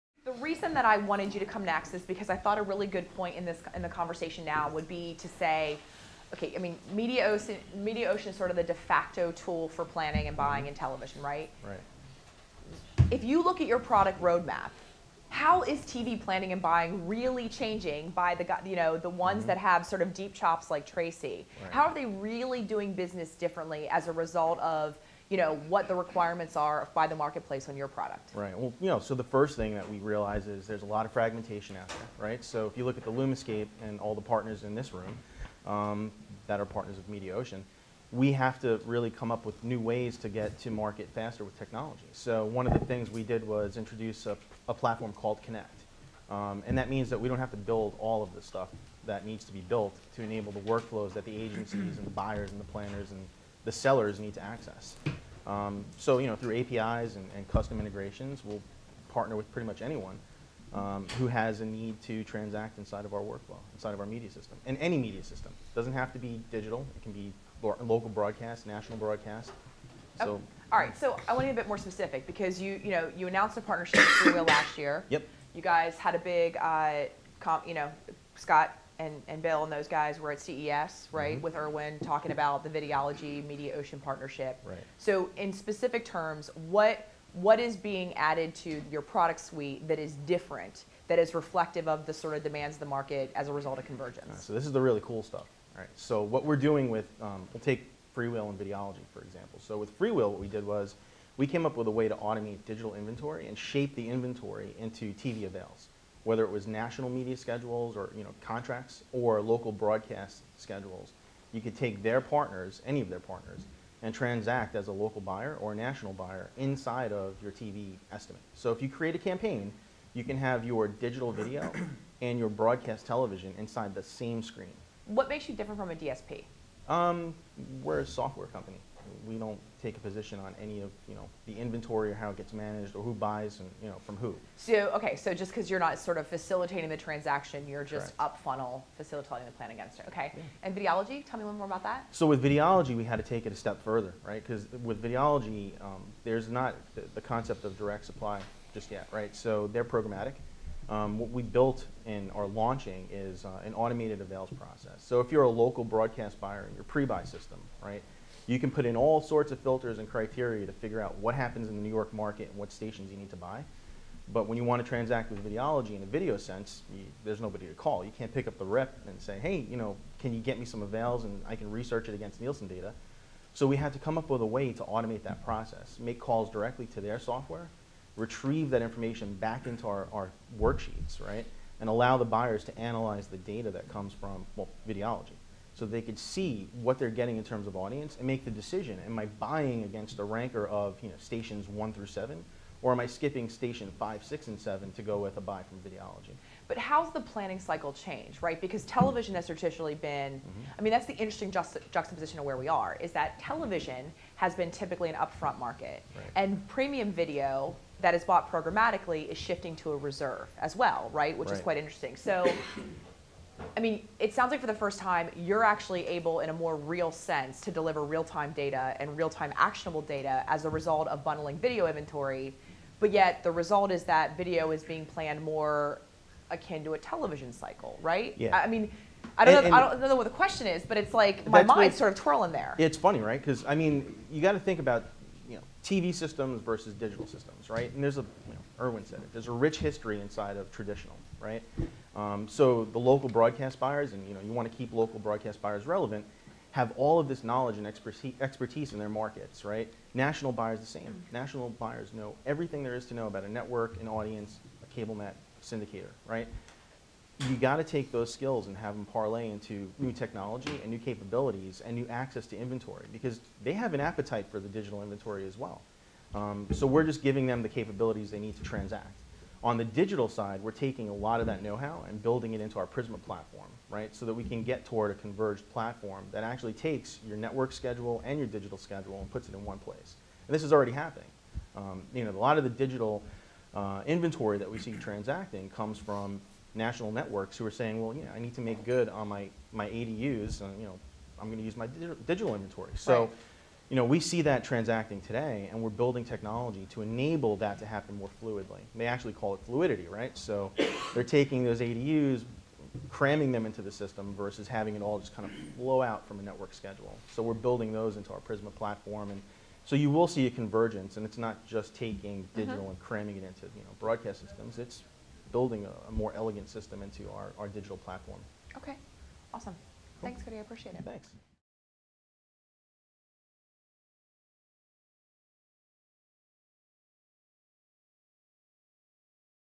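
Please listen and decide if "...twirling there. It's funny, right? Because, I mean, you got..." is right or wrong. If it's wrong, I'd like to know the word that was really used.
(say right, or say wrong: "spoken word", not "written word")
right.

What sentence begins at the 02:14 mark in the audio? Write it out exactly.
So okay, so just because you're not sort of facilitating the transaction, you're just Correct.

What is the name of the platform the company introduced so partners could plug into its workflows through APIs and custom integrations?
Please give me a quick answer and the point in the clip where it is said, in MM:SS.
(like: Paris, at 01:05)
Connect, at 00:45.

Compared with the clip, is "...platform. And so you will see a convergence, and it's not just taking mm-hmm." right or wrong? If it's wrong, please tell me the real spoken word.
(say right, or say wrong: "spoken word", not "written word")
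right.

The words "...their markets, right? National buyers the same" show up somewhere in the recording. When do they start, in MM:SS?
04:08.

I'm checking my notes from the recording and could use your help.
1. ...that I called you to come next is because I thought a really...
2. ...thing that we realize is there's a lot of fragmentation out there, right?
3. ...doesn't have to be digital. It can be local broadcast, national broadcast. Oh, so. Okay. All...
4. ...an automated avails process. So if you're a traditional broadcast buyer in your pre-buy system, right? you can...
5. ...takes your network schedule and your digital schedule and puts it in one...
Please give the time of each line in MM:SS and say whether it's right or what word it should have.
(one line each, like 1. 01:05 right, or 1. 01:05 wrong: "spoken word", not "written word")
1. 00:00 wrong: "wanted", not "called"
2. 00:29 right
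3. 01:05 right
4. 02:33 wrong: "local", not "traditional"
5. 04:36 right.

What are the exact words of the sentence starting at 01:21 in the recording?
with Irwin talking about the Videology Mediaocean partnership.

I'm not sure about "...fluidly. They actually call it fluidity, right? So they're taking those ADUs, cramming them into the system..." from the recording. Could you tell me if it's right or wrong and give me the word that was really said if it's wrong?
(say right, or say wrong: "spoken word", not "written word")
right.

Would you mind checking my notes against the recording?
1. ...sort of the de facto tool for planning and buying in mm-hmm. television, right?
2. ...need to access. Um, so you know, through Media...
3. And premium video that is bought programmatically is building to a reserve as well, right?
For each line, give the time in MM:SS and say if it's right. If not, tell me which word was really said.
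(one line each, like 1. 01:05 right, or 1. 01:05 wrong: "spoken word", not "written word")
1. 00:08 right
2. 00:54 wrong: "APIs", not "Media"
3. 03:26 wrong: "shifting", not "building".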